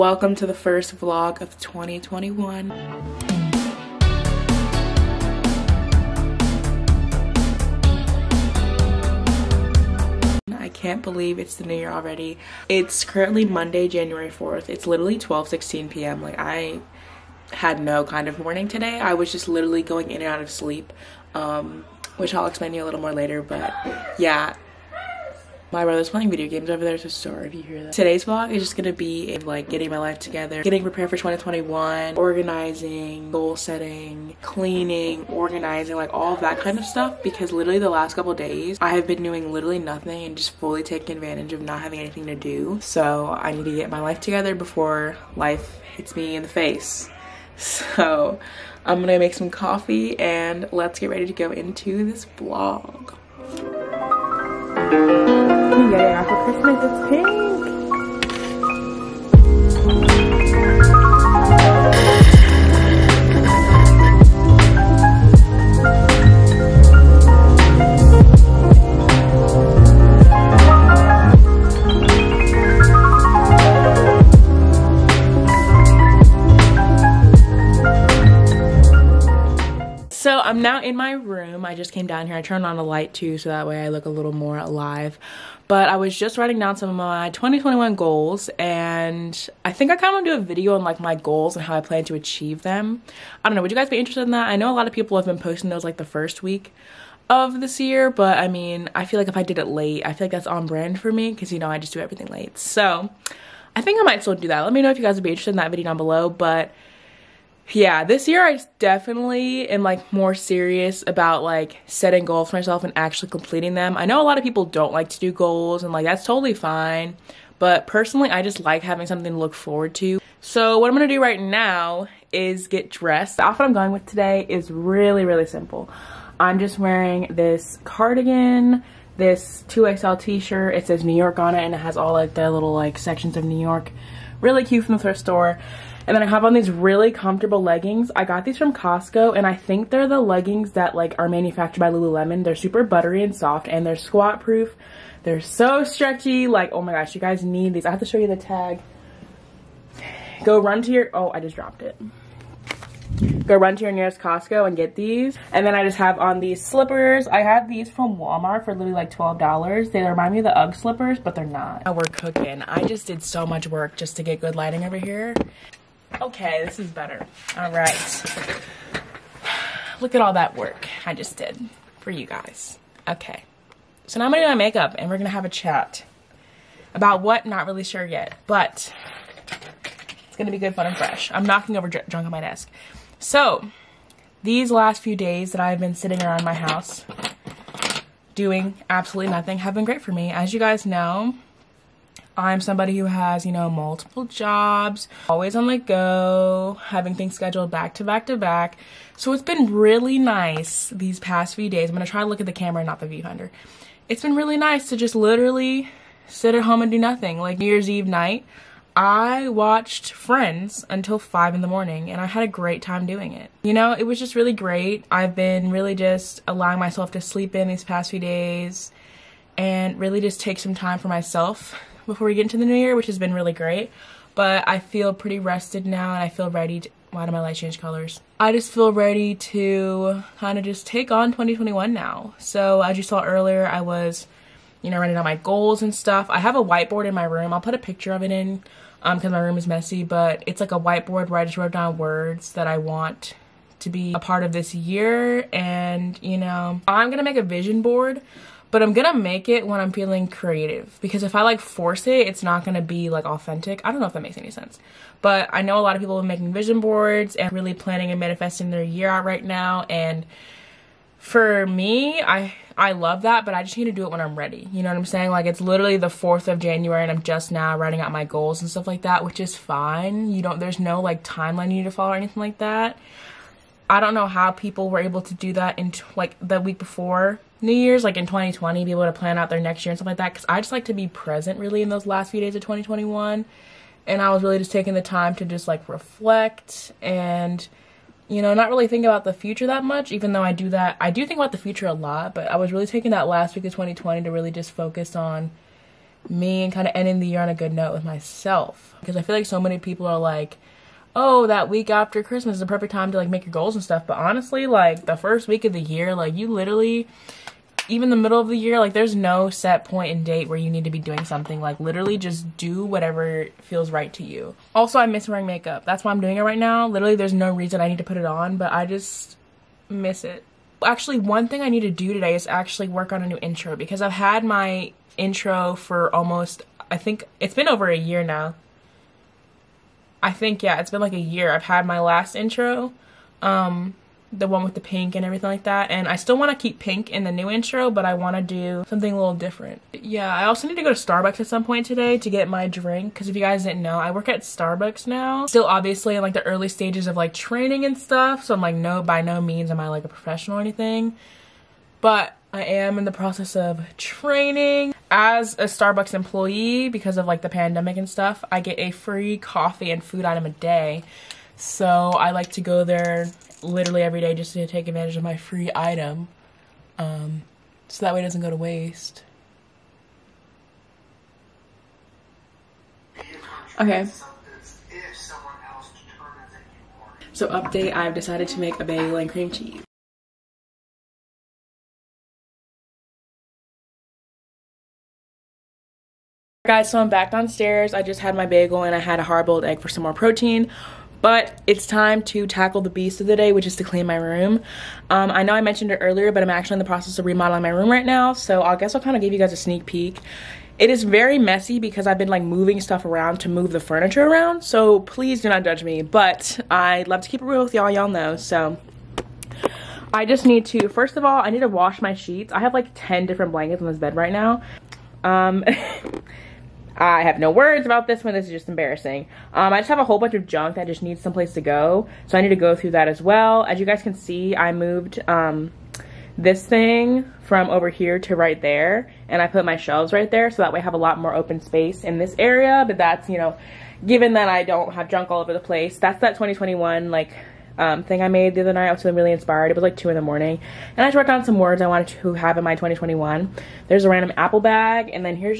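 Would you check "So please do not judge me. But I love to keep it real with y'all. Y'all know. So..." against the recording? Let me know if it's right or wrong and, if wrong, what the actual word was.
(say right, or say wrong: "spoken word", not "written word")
right.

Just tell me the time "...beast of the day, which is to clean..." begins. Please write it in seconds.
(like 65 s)
392 s.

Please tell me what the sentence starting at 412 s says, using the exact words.
I have like 10 different blankets on this bed right now.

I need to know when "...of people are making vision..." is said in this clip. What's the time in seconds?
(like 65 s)
255 s.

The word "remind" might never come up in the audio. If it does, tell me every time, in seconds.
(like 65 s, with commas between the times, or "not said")
160 s.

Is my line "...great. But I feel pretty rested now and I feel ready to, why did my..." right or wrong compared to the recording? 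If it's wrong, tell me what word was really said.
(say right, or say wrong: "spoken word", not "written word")
right.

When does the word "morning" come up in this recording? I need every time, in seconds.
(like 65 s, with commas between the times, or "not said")
18 s, 211 s, 440 s.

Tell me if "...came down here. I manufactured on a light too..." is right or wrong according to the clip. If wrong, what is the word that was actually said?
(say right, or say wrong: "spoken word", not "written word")
wrong: "turned", not "manufactured".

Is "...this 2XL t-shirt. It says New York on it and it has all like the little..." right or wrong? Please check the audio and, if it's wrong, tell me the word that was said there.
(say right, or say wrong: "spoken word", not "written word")
right.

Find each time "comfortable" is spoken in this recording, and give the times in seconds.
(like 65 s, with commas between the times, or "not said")
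137 s.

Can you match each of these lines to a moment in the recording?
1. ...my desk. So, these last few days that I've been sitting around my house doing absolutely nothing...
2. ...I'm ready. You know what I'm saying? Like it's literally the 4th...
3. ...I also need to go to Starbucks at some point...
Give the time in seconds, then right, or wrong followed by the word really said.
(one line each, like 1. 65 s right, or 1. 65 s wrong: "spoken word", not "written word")
1. 182 s right
2. 264 s right
3. 340 s right.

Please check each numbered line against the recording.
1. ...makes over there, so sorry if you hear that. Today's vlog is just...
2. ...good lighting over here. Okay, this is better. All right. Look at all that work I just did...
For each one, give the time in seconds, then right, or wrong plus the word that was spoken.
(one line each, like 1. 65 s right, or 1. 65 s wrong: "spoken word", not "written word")
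1. 26 s wrong: "games", not "makes"
2. 164 s right.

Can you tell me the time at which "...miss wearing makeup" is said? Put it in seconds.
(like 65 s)
315 s.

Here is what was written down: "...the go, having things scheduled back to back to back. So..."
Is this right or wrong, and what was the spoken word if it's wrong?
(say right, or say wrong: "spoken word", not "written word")
right.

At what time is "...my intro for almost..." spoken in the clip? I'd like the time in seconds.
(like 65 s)
324 s.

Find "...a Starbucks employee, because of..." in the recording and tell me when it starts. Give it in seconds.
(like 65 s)
355 s.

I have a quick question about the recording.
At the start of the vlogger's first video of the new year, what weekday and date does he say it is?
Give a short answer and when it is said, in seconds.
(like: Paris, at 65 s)
Monday, January 4th, at 13 s.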